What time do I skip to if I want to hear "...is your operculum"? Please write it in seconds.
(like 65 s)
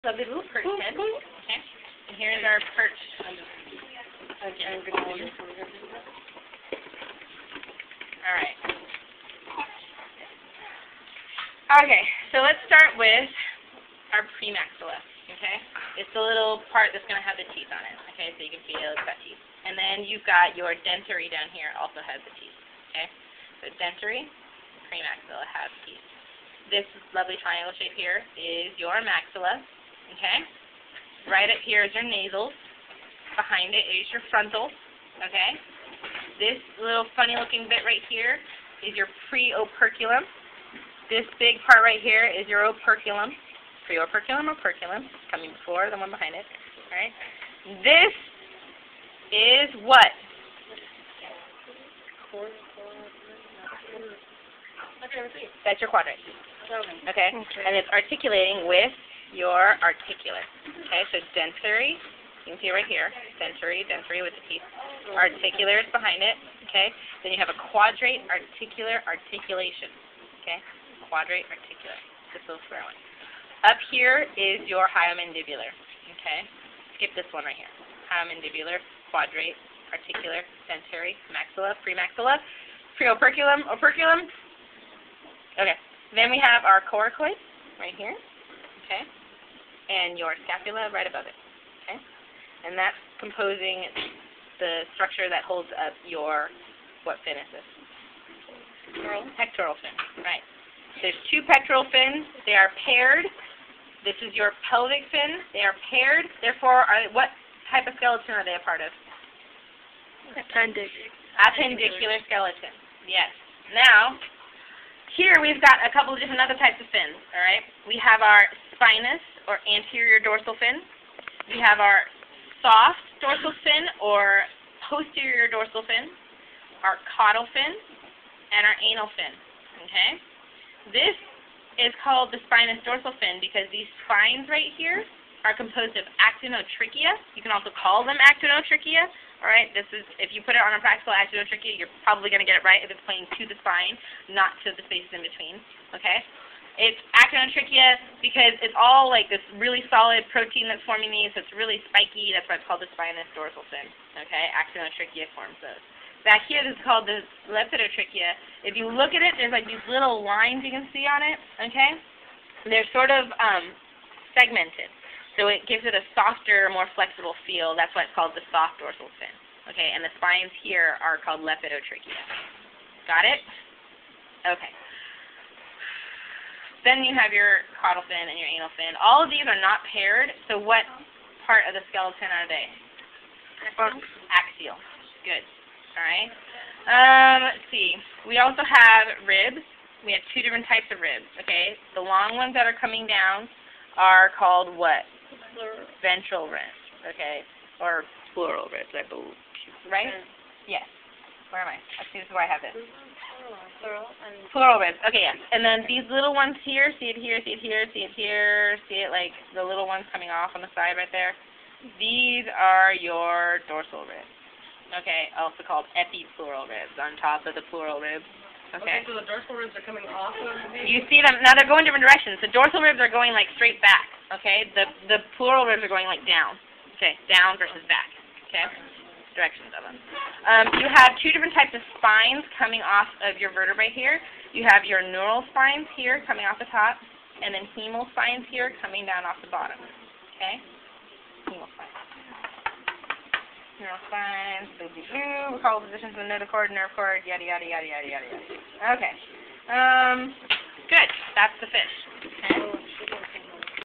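42 s.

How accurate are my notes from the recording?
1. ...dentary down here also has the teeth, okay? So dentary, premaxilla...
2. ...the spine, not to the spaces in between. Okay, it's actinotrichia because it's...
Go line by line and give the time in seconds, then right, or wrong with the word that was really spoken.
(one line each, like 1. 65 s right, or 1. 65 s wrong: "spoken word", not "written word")
1. 20 s right
2. 143 s right.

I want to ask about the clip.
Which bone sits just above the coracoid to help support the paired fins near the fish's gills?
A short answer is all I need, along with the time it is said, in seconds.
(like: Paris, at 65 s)
scapula, at 90 s.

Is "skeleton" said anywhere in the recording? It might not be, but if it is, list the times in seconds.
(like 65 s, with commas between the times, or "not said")
107 s, 112 s, 181 s.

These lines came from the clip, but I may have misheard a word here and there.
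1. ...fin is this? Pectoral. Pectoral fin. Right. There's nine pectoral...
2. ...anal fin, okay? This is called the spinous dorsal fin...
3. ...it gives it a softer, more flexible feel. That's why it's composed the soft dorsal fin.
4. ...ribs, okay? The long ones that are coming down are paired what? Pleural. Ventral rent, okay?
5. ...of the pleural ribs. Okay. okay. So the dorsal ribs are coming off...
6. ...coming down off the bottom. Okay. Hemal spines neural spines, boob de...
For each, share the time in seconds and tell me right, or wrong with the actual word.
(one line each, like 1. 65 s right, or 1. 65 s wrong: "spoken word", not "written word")
1. 97 s wrong: "two", not "nine"
2. 128 s right
3. 165 s wrong: "called", not "composed"
4. 190 s wrong: "called", not "paired"
5. 217 s right
6. 238 s right.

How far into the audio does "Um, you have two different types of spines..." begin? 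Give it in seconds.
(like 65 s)
230 s.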